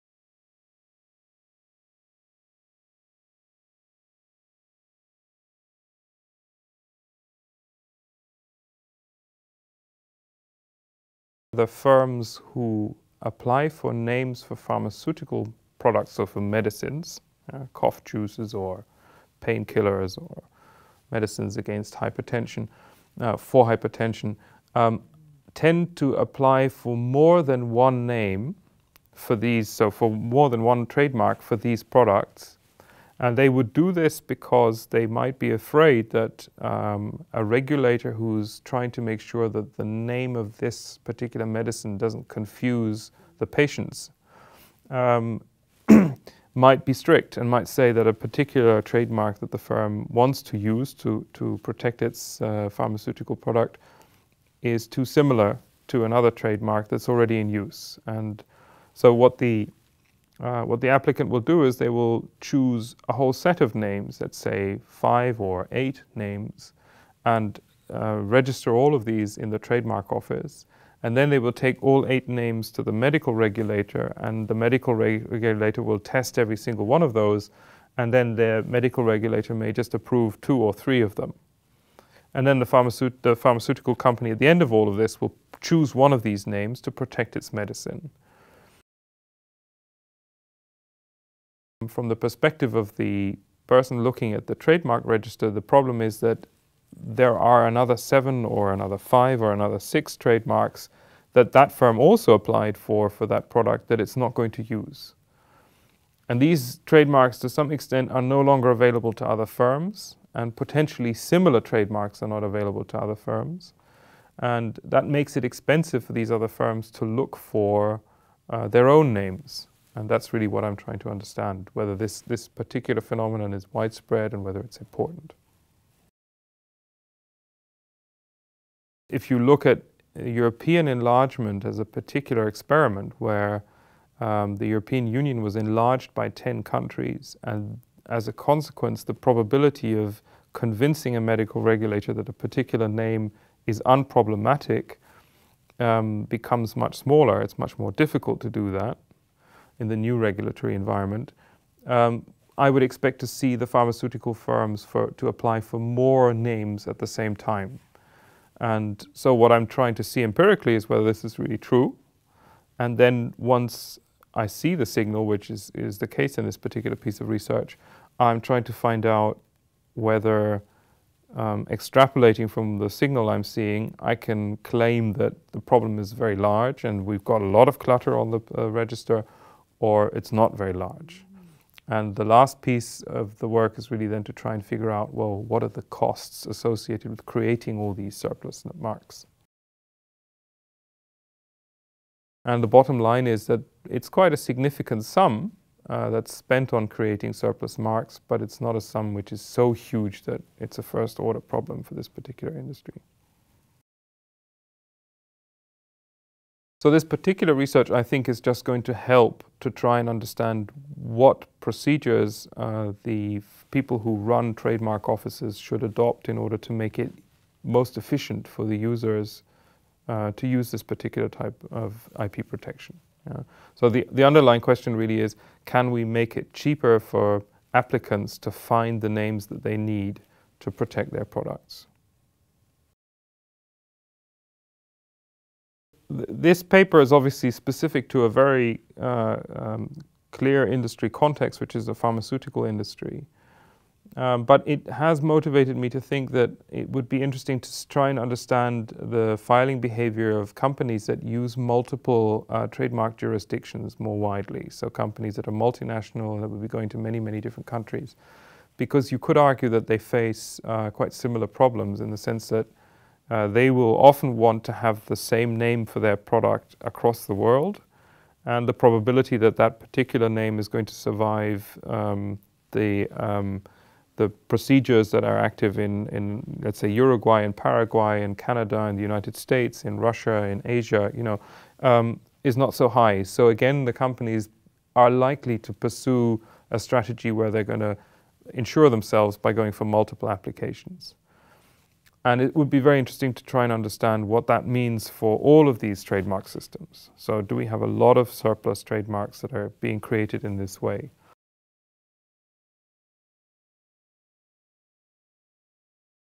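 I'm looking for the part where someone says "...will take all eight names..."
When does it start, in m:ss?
1:11.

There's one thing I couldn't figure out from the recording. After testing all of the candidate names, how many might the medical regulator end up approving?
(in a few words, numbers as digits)
2 or 3.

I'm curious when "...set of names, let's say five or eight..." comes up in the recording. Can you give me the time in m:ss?
1:03.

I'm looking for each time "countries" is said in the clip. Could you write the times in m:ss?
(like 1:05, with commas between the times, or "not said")
2:16, 4:17.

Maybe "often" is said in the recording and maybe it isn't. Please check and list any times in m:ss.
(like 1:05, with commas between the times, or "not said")
4:24.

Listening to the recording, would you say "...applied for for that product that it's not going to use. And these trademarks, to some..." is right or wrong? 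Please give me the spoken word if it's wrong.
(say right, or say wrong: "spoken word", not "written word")
right.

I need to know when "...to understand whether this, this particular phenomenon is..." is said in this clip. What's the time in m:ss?
2:00.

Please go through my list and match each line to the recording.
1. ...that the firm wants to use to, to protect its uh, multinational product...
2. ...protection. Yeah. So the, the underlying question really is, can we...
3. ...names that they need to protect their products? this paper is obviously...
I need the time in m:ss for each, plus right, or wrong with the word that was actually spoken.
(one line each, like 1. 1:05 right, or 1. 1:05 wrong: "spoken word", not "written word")
1. 0:49 wrong: "pharmaceutical", not "multinational"
2. 3:42 right
3. 3:49 right.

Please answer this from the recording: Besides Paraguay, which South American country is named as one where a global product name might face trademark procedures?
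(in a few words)
Uruguay.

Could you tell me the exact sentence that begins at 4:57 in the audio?
So, do we have a lot of surplus trademarks that are being created in this way?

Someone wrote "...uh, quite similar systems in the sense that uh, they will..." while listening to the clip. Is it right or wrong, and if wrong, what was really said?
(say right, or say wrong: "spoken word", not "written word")
wrong: "problems", not "systems".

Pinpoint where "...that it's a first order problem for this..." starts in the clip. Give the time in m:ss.
3:20.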